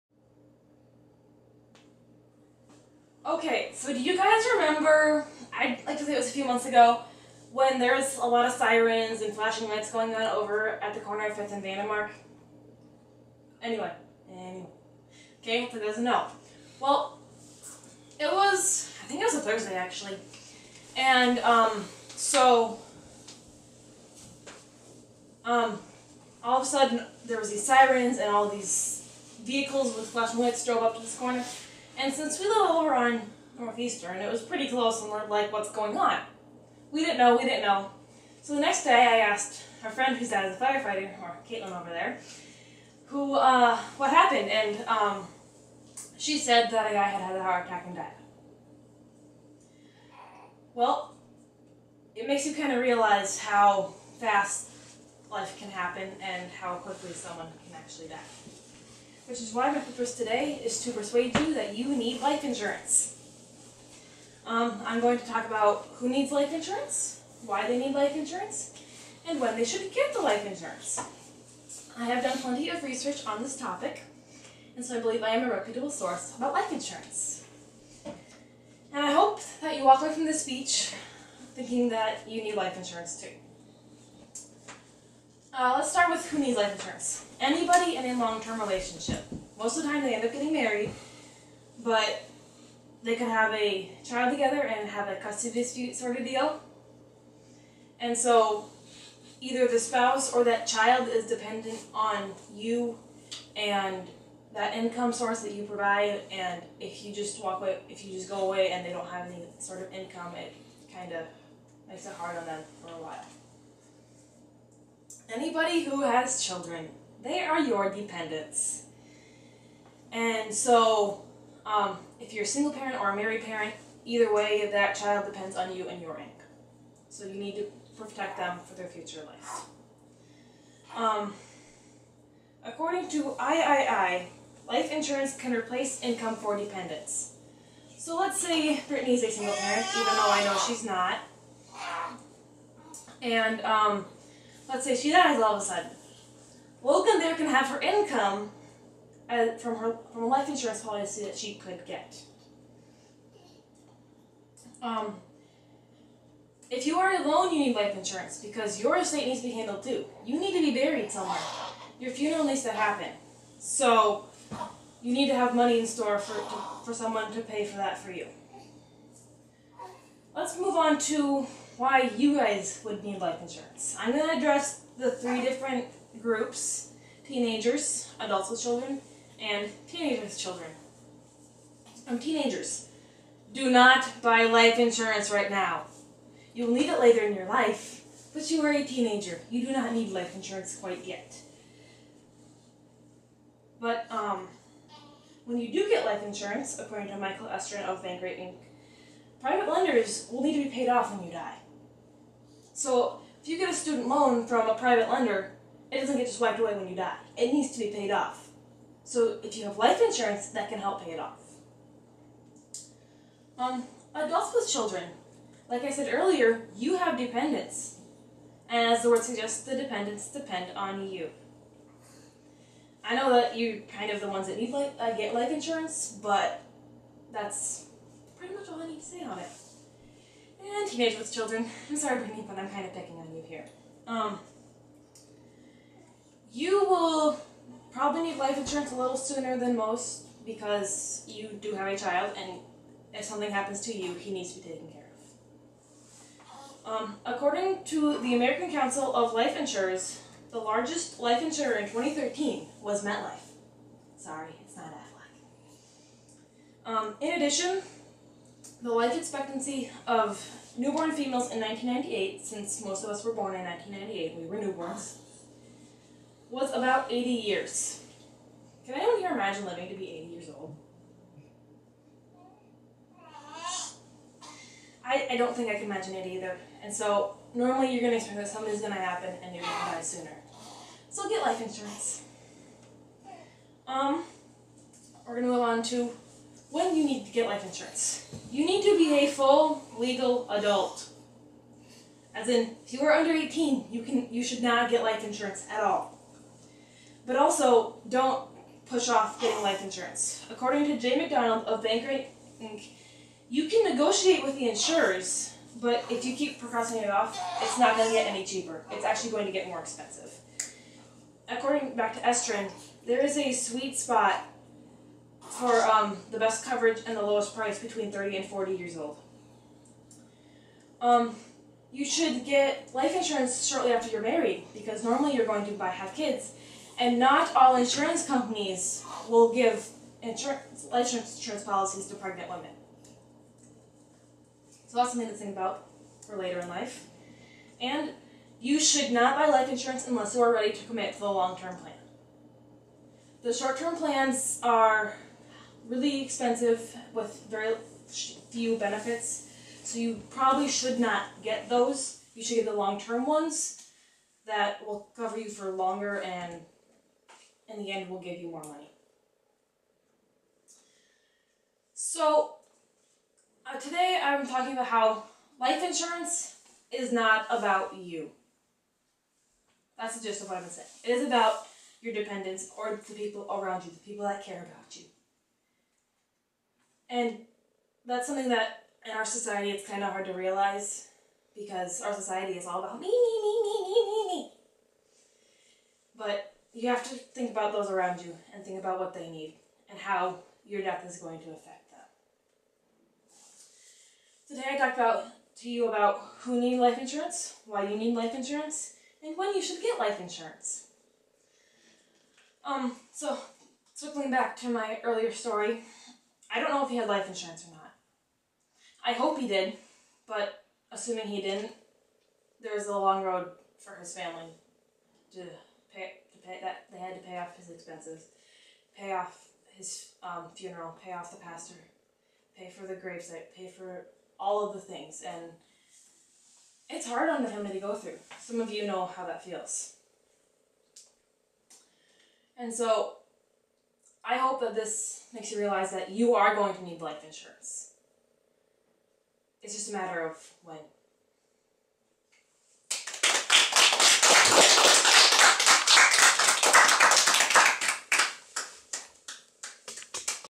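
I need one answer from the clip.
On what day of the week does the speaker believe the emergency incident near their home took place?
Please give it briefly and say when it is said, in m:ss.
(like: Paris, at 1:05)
Thursday, at 0:19.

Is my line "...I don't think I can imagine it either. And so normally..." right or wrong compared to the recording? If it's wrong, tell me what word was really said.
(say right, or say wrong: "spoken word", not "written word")
right.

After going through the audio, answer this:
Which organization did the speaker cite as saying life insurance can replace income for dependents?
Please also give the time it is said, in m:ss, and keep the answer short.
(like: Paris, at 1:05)
III, at 2:13.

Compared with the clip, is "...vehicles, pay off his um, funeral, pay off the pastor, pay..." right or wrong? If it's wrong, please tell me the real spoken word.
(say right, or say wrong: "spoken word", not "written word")
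wrong: "expenses", not "vehicles".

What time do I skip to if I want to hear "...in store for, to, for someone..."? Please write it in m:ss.
2:45.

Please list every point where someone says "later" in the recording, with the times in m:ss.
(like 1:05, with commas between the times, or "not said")
3:06, 5:36.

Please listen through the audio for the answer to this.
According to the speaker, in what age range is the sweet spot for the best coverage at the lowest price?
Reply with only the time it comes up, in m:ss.
5:17.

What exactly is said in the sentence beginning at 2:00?
And so, um, if you're a single parent or a married parent, either way, that child depends on you and your income.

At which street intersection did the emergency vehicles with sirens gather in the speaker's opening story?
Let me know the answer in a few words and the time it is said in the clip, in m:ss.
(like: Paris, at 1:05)
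5th and Vandermark, at 0:11.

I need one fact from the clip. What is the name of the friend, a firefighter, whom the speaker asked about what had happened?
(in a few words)
Caitlin.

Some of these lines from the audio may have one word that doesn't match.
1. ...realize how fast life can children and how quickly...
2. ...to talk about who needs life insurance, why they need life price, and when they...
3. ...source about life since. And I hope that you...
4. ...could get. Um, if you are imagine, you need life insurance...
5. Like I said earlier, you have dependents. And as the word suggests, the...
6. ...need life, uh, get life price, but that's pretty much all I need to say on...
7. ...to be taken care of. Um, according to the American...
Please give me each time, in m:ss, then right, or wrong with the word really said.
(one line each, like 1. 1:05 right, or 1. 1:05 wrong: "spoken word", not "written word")
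1. 0:52 wrong: "happen", not "children"
2. 1:05 wrong: "insurance", not "price"
3. 1:15 wrong: "insurance", not "since"
4. 2:31 wrong: "alone", not "imagine"
5. 3:35 right
6. 3:44 wrong: "insurance", not "price"
7. 4:04 right.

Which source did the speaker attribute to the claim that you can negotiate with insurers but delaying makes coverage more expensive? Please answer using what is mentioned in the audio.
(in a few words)
Jay McDonald.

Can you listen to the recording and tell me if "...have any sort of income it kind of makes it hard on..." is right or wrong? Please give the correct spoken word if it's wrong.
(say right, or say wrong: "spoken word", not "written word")
right.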